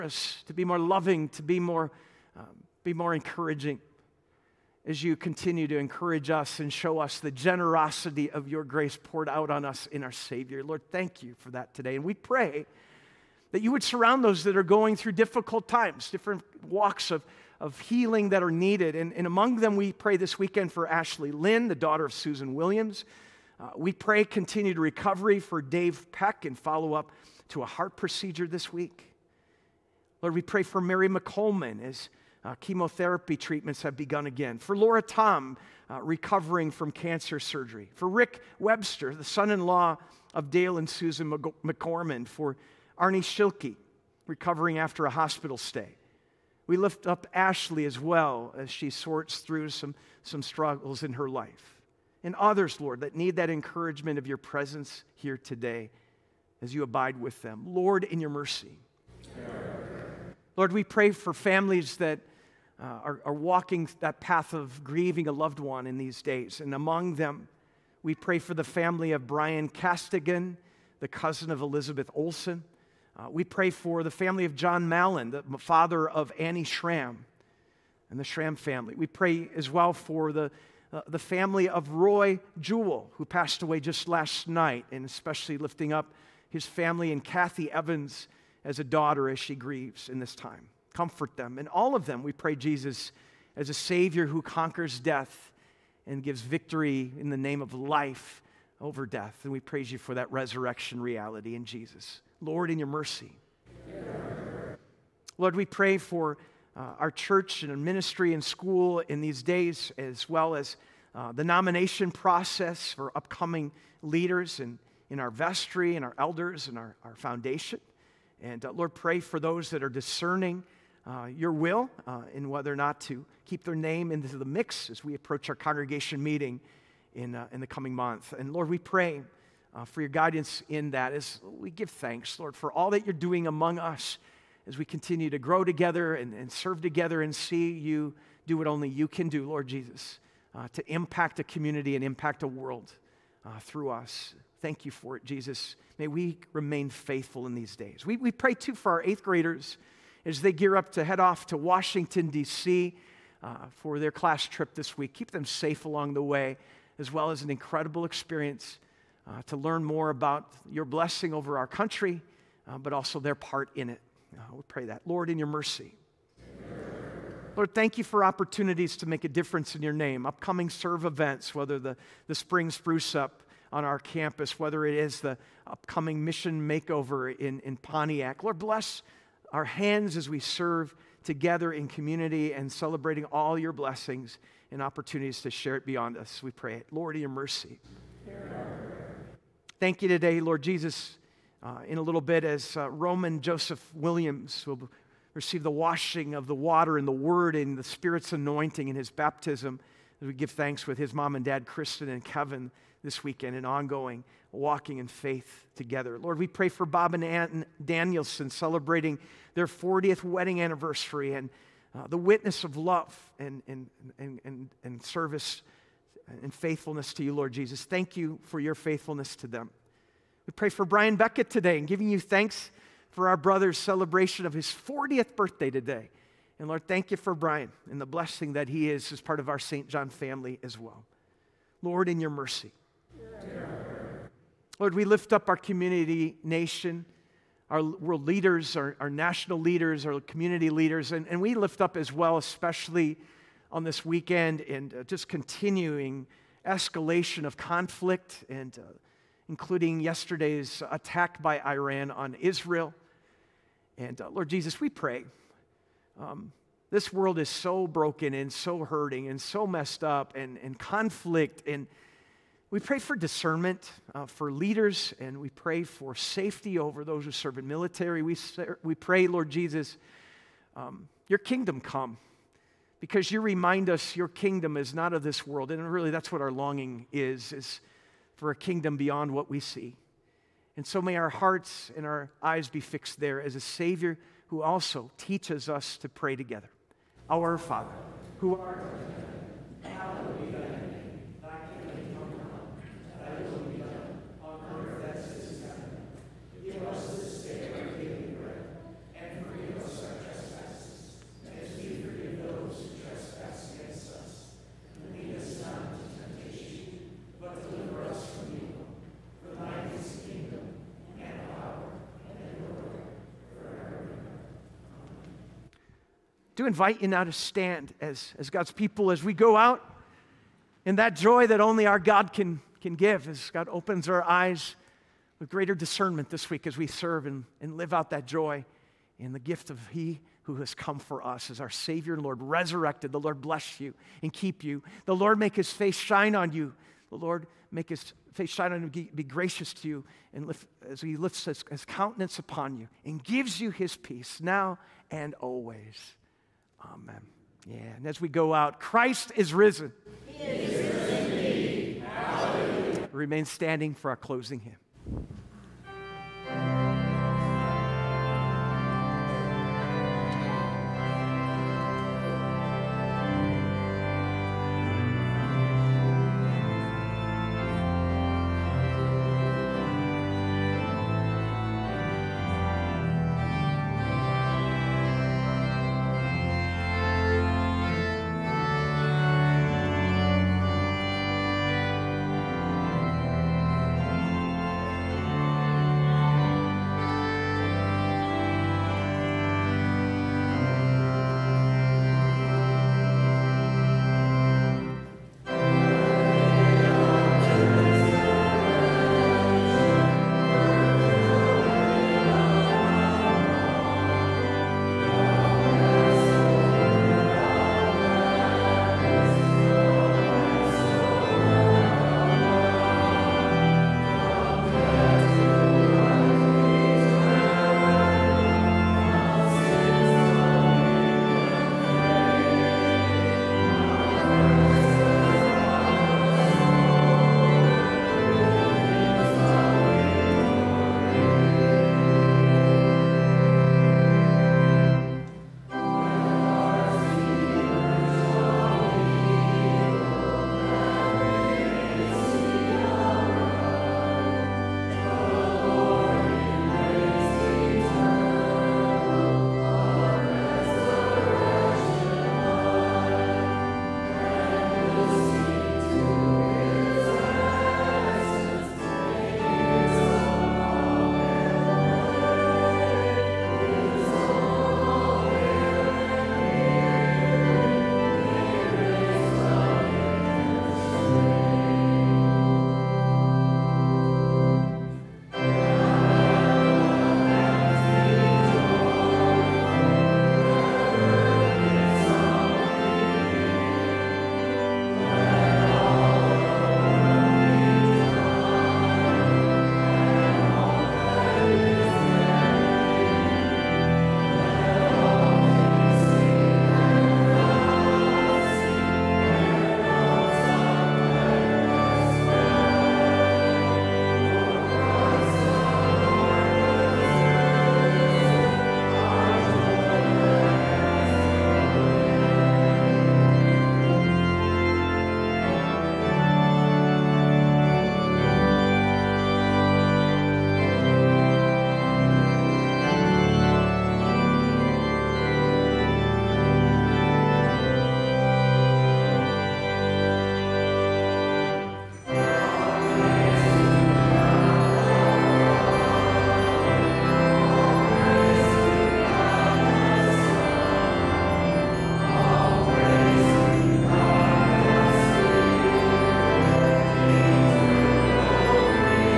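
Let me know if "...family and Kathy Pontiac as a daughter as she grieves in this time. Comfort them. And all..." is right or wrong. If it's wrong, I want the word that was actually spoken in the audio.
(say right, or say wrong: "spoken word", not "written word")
wrong: "Evans", not "Pontiac".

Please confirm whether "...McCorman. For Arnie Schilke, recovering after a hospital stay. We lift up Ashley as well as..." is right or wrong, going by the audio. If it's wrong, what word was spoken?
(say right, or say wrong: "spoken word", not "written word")
right.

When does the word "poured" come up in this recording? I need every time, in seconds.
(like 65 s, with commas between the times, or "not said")
9 s.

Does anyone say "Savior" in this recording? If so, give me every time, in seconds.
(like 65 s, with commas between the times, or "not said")
10 s, 93 s, 283 s, 331 s.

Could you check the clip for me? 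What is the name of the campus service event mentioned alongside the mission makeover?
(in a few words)
spring spruce up.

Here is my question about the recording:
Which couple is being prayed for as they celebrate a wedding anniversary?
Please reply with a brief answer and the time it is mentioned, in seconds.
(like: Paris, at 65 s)
Bob and Ann Danielson, at 206 s.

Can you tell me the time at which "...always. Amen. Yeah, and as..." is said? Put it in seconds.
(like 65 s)
345 s.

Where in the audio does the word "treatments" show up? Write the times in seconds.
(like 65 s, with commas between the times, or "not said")
33 s.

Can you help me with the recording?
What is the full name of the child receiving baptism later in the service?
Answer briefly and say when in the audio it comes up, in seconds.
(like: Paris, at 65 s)
Roman Joseph Williams, at 192 s.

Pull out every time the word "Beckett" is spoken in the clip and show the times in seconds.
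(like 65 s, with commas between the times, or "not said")
221 s.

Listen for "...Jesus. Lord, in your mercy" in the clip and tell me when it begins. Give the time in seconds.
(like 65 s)
101 s.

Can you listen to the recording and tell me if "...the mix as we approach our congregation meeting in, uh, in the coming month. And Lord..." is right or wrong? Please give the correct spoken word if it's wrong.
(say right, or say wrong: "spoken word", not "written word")
right.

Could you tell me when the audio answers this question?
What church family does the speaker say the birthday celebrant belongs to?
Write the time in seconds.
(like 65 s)
229 s.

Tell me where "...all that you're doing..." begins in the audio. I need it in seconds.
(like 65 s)
132 s.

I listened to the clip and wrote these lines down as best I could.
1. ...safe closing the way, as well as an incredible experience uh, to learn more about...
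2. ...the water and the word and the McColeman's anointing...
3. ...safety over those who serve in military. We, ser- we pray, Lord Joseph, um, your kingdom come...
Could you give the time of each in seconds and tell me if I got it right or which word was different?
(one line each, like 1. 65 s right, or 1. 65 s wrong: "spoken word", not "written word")
1. 155 s wrong: "along", not "closing"
2. 196 s wrong: "Spirit", not "McColeman"
3. 266 s wrong: "Jesus", not "Joseph".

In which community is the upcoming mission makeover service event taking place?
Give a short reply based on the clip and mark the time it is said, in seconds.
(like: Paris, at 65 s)
Pontiac, at 177 s.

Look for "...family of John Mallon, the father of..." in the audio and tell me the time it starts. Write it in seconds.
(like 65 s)
74 s.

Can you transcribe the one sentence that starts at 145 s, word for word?
May we remain faithful in these days.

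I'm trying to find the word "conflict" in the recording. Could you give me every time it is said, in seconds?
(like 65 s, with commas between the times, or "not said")
247 s, 260 s.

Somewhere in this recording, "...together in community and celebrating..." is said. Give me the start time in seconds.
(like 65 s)
181 s.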